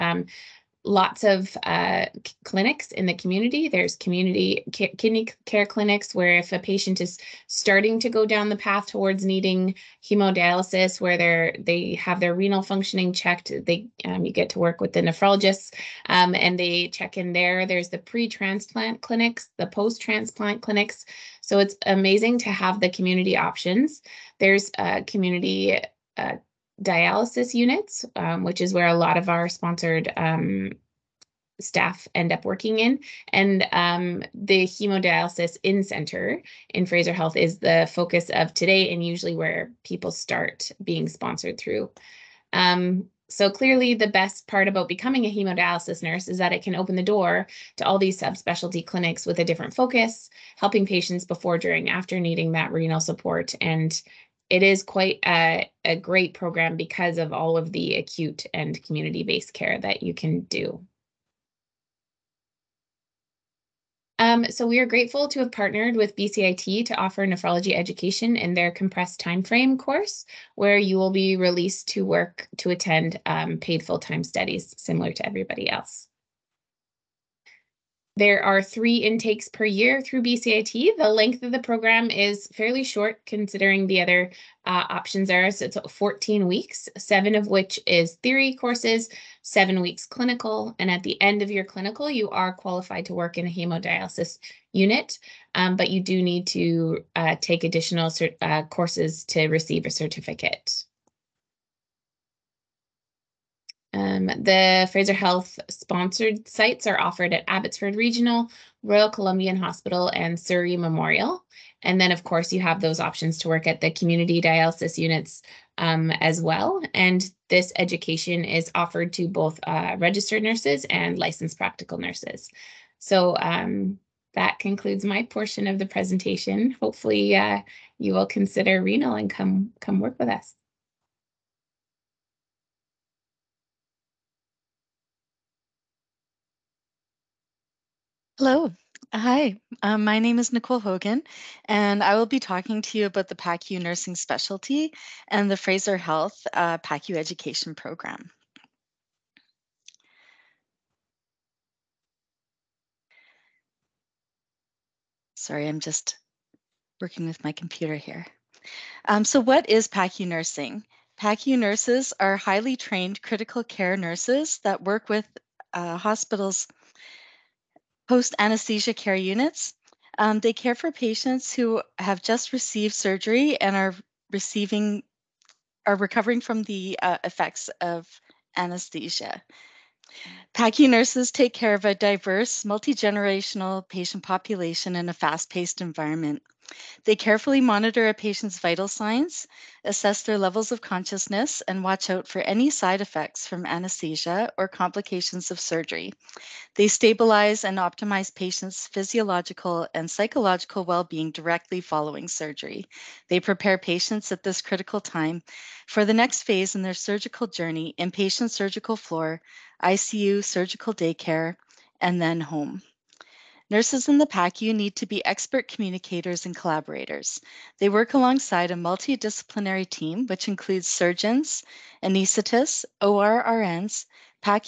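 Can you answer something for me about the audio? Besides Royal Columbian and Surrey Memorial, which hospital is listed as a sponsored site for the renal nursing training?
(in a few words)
Abbotsford Regional.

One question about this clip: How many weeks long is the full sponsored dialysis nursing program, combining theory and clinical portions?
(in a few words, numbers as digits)
14 weeks.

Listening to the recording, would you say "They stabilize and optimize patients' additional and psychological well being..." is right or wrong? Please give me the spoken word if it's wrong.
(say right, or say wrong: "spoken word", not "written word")
wrong: "physiological", not "additional".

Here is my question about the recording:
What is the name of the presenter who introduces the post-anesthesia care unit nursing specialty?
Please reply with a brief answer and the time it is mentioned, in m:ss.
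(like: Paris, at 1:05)
Nicole Hogan, at 2:20.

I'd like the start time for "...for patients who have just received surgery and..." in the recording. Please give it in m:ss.
2:50.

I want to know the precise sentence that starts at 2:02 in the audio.
So um, that concludes my portion of the presentation.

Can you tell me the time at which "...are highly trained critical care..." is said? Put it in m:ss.
2:42.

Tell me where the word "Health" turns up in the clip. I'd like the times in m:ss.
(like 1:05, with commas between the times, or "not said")
0:37, 1:45, 2:25.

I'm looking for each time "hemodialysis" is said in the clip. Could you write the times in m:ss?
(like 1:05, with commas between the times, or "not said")
0:10, 0:34, 0:45, 1:33.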